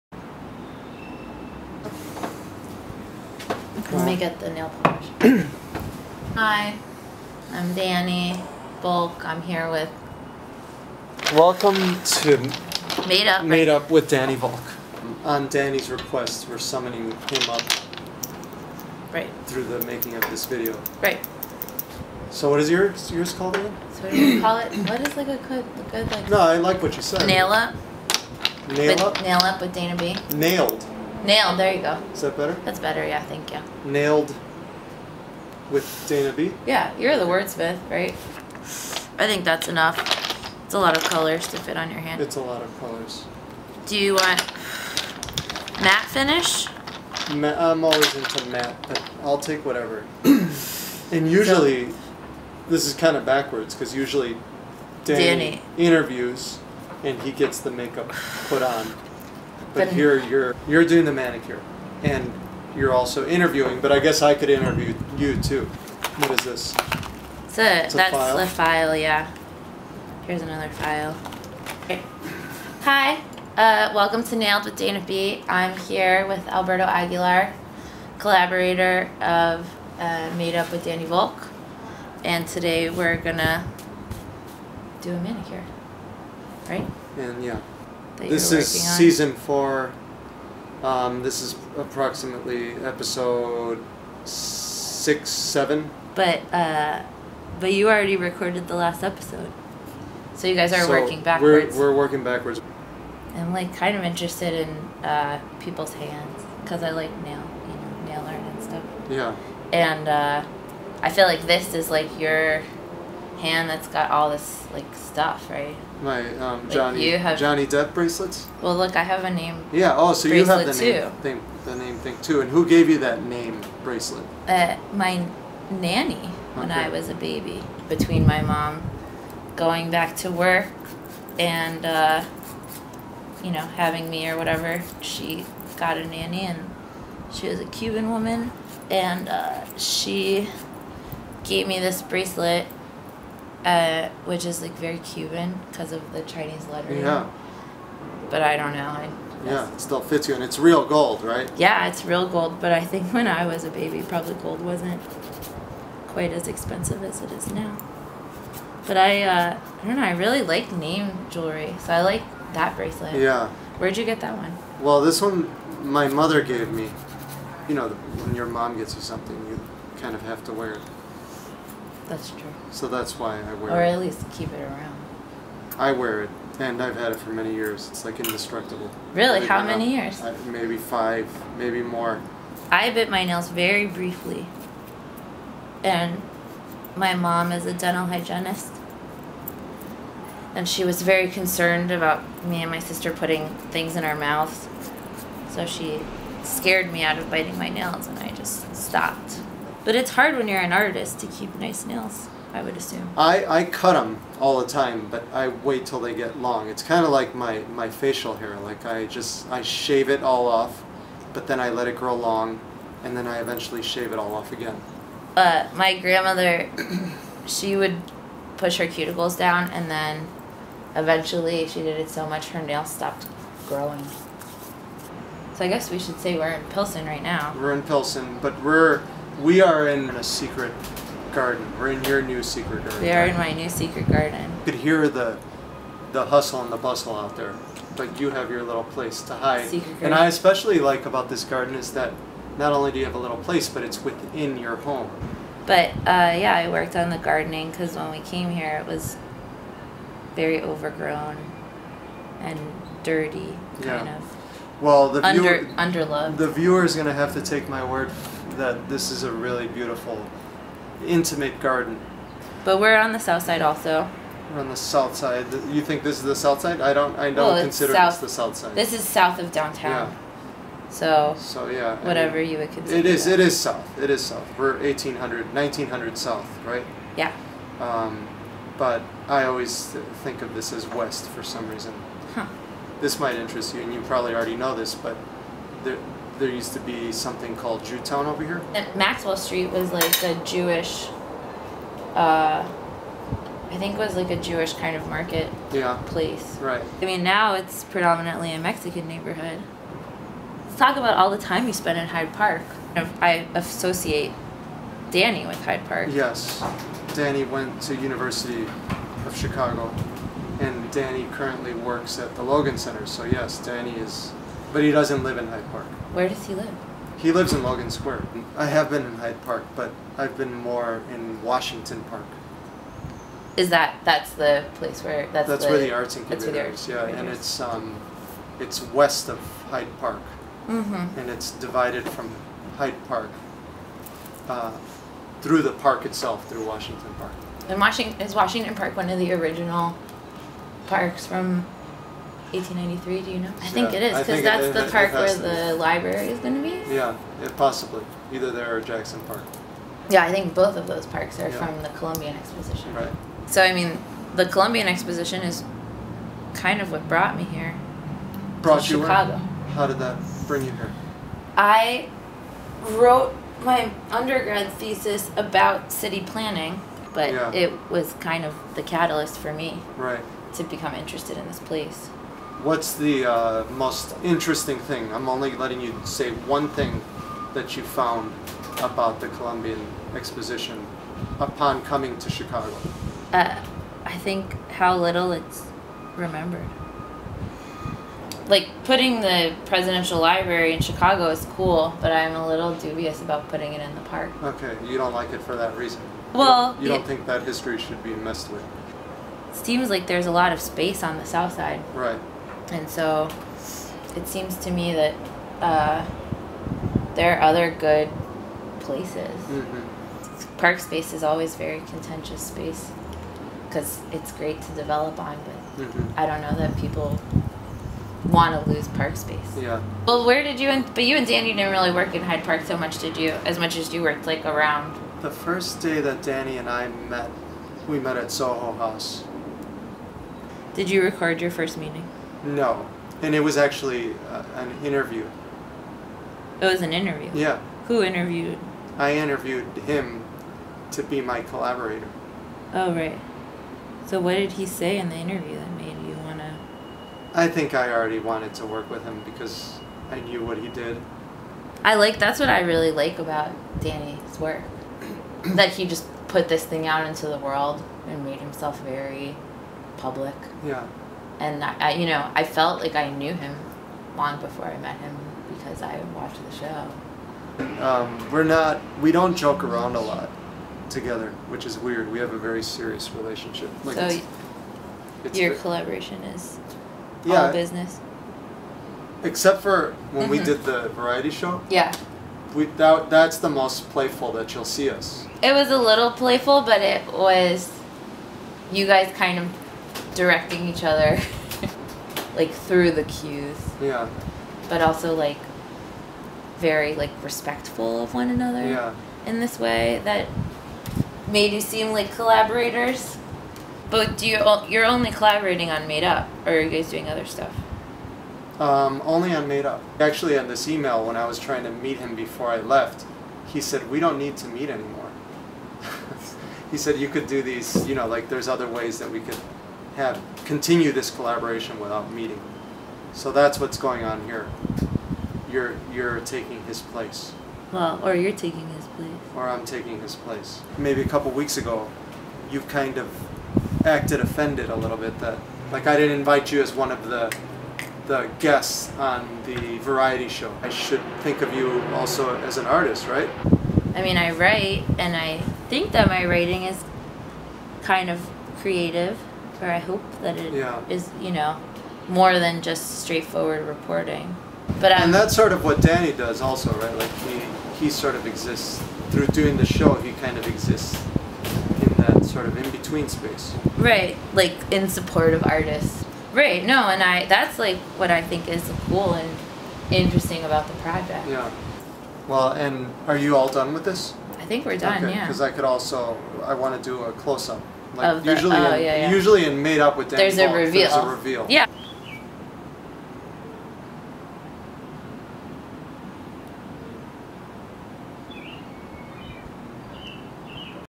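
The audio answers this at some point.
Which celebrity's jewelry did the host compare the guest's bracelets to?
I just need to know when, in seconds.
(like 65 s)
117 s.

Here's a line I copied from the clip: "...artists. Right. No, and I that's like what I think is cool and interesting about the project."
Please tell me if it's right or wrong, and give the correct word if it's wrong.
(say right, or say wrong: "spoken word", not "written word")
right.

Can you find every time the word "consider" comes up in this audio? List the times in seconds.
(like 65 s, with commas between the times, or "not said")
267 s, 272 s.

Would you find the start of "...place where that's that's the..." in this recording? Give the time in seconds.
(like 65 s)
324 s.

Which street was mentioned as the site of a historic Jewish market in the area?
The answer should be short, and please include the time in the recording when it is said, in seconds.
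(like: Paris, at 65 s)
Maxwell Street, at 288 s.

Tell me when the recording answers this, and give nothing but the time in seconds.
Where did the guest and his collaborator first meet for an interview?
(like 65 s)
428 s.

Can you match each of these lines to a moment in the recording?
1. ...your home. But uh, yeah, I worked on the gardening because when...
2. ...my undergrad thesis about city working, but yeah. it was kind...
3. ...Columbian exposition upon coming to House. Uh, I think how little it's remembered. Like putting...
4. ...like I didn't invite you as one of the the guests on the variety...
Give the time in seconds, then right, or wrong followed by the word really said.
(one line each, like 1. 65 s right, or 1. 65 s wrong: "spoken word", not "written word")
1. 244 s right
2. 363 s wrong: "planning", not "working"
3. 379 s wrong: "Chicago", not "House"
4. 535 s right.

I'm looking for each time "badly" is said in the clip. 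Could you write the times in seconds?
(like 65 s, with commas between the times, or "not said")
not said.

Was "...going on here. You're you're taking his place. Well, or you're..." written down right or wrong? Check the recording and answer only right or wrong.
right.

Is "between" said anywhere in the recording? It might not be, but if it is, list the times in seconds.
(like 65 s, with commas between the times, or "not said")
127 s, 562 s.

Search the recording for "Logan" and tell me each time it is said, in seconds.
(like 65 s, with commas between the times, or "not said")
312 s, 317 s.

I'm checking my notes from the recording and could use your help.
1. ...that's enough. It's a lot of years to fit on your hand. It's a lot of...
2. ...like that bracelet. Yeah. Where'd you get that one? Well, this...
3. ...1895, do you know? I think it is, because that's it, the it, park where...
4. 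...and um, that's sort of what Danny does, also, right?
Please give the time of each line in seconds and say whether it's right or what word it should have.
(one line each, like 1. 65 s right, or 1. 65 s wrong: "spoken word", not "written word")
1. 39 s wrong: "colors", not "years"
2. 162 s right
3. 342 s wrong: "1893", not "1895"
4. 554 s right.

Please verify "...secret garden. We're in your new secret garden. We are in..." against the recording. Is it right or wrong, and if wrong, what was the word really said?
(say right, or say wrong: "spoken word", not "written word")
right.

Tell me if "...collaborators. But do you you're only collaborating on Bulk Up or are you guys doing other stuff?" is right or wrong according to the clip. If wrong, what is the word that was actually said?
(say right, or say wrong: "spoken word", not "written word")
wrong: "Made", not "Bulk".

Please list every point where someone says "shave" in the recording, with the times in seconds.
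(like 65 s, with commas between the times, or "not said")
209 s, 213 s.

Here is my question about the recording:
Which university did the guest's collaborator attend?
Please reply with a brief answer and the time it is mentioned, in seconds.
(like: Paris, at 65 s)
University of Chicago, at 307 s.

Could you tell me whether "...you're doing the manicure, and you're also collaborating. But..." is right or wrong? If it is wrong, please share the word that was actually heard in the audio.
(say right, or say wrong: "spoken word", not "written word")
wrong: "interviewing", not "collaborating".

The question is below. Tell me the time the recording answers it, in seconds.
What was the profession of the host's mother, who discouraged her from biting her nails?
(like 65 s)
187 s.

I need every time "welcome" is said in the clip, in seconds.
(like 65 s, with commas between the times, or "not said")
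11 s, 73 s.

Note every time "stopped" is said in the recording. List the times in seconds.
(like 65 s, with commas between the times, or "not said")
198 s, 222 s.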